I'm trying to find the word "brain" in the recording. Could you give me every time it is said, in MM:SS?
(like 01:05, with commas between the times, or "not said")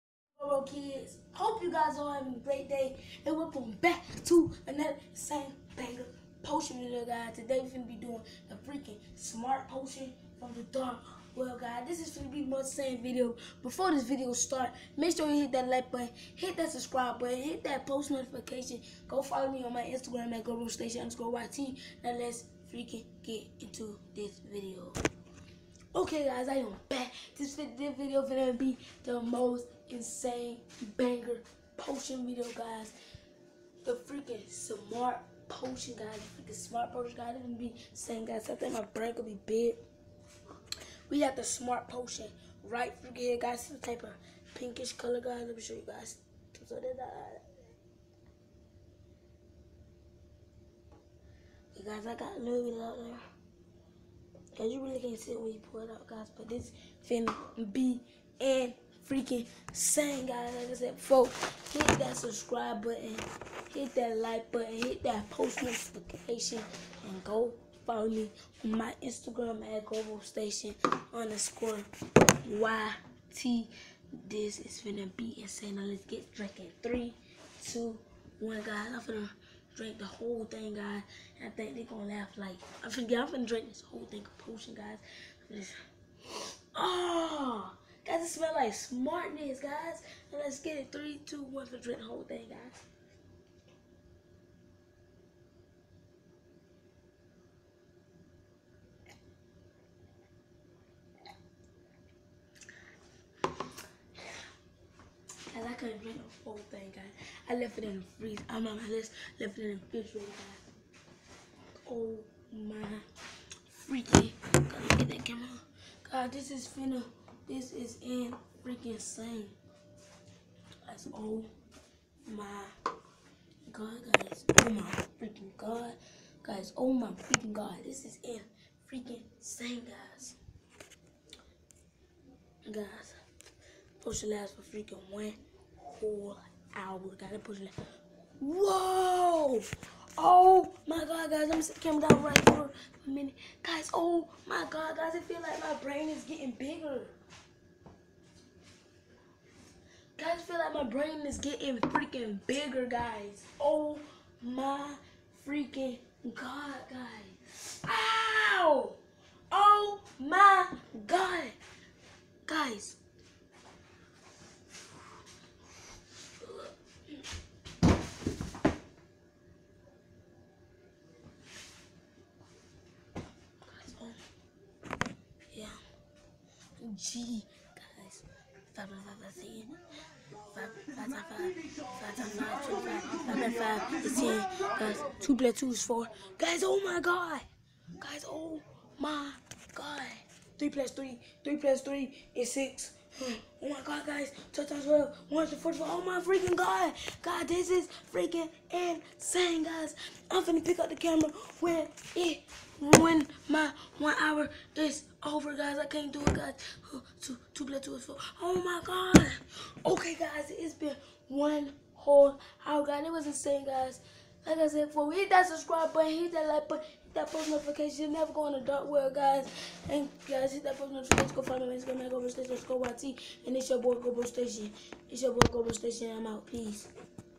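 00:38, 02:25, 02:30.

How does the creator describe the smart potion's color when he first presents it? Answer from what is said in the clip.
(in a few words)
pinkish.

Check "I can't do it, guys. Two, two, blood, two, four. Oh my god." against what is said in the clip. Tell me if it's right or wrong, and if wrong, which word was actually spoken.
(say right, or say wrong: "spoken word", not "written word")
right.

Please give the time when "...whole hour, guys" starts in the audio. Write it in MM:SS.
03:31.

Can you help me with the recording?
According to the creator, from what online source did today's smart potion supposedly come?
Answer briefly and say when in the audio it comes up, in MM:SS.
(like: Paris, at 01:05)
dark web, at 00:10.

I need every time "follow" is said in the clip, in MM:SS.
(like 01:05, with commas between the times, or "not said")
00:19, 01:07, 03:41.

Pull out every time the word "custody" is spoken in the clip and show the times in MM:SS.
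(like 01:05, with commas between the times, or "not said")
not said.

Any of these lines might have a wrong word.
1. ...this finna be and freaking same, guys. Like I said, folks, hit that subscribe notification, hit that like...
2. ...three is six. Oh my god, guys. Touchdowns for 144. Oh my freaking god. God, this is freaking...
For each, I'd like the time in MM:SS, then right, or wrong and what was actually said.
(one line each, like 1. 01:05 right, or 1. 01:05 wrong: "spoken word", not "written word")
1. 00:56 wrong: "button", not "notification"
2. 03:11 right.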